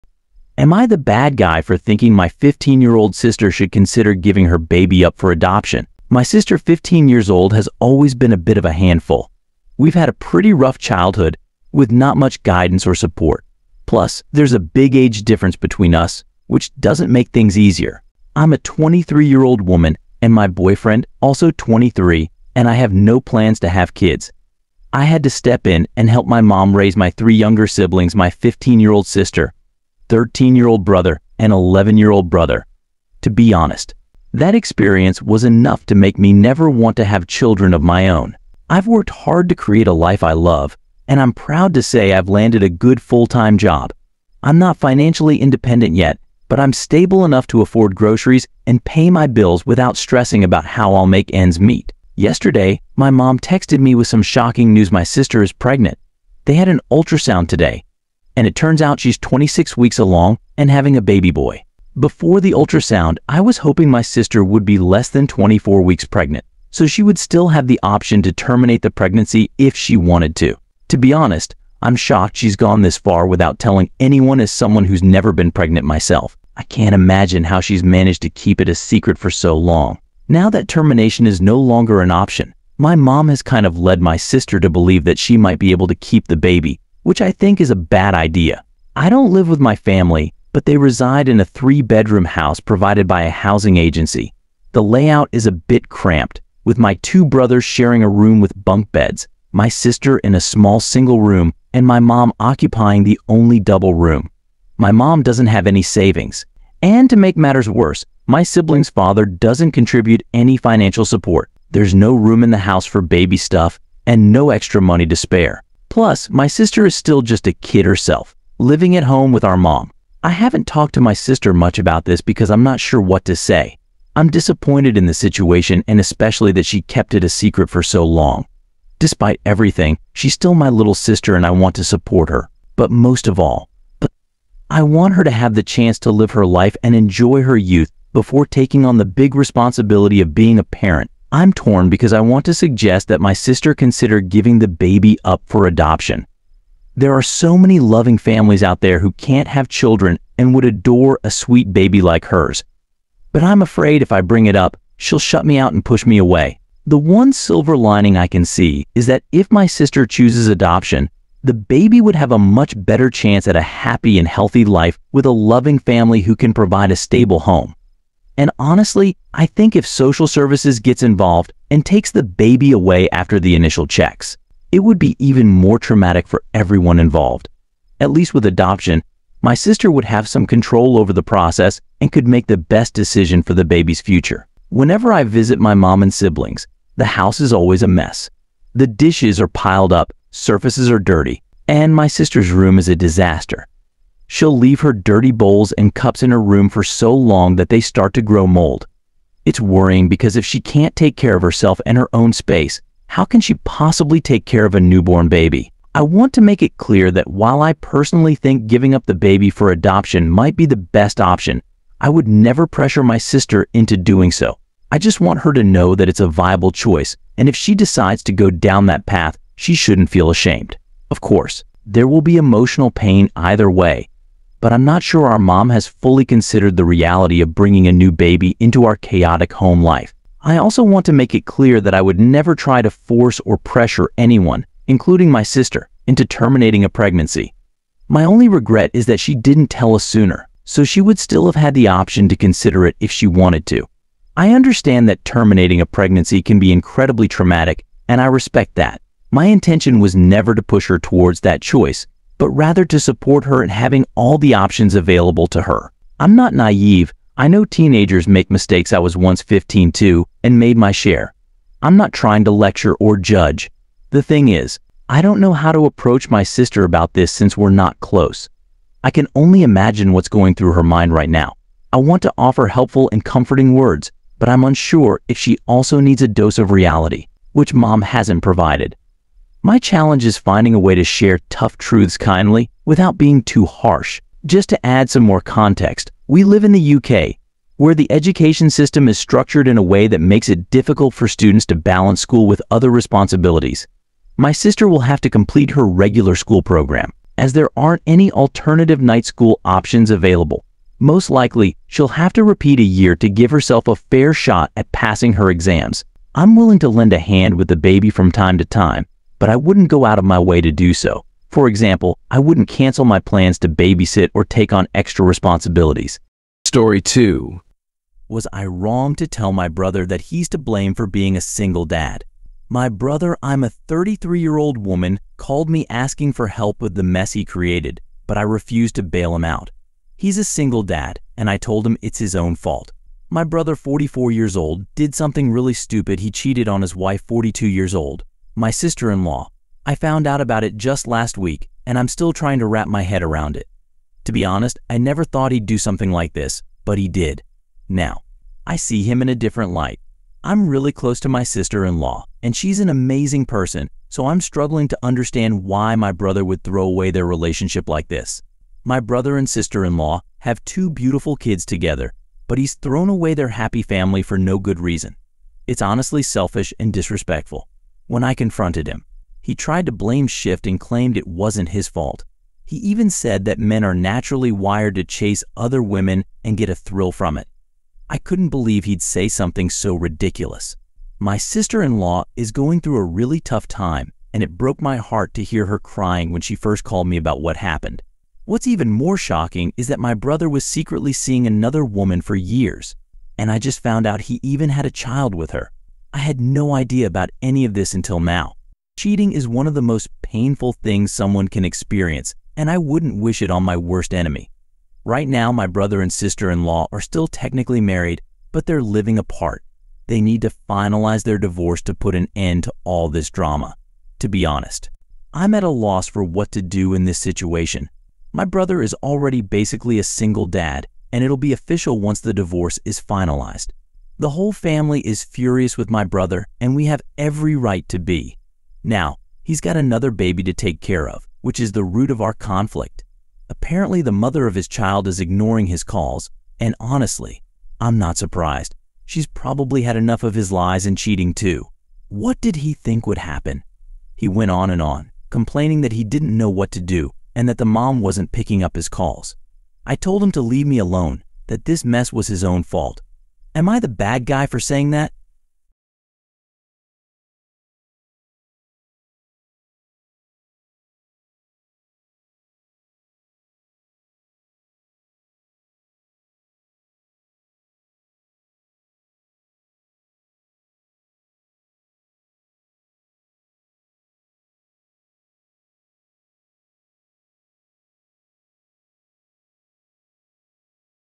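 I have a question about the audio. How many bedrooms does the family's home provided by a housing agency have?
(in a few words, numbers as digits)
3.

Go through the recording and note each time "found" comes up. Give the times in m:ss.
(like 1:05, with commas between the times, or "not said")
5:39, 6:33.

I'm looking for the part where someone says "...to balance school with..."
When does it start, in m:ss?
4:51.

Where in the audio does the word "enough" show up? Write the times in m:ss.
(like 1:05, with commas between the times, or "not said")
0:35, 0:47, 7:19.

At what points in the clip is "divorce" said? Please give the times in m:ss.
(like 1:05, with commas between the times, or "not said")
6:51, 7:02.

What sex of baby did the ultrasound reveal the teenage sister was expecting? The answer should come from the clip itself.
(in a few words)
boy.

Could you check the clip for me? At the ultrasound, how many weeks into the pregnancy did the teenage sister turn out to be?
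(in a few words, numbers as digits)
26.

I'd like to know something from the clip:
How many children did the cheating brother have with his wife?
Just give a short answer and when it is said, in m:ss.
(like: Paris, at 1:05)
2, at 6:00.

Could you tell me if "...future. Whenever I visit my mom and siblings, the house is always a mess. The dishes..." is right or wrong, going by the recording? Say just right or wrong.
right.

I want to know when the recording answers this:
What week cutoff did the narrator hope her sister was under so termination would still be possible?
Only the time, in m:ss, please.
1:05.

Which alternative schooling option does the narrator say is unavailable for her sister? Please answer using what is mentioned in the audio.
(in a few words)
night school.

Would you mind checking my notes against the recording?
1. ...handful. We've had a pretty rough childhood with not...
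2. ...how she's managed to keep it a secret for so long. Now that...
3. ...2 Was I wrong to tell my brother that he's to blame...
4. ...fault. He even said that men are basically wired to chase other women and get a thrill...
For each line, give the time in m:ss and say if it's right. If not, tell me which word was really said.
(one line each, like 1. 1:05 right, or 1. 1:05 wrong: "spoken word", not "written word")
1. 0:08 right
2. 1:17 right
3. 5:17 right
4. 6:11 wrong: "naturally", not "basically".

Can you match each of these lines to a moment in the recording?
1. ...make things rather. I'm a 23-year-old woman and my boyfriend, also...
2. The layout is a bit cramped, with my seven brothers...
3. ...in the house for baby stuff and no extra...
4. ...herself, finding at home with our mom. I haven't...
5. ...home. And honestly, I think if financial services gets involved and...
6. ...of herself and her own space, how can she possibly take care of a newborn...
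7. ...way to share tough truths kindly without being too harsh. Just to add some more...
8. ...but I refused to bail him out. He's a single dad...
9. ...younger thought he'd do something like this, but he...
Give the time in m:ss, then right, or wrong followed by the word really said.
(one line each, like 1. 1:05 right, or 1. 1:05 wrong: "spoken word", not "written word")
1. 0:17 wrong: "easier", not "rather"
2. 1:34 wrong: "two", not "seven"
3. 1:52 right
4. 1:57 wrong: "living", not "finding"
5. 2:47 wrong: "social", not "financial"
6. 3:21 right
7. 4:40 right
8. 5:28 right
9. 5:44 wrong: "never", not "younger".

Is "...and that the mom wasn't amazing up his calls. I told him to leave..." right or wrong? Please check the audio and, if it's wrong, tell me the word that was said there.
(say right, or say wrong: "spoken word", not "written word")
wrong: "picking", not "amazing".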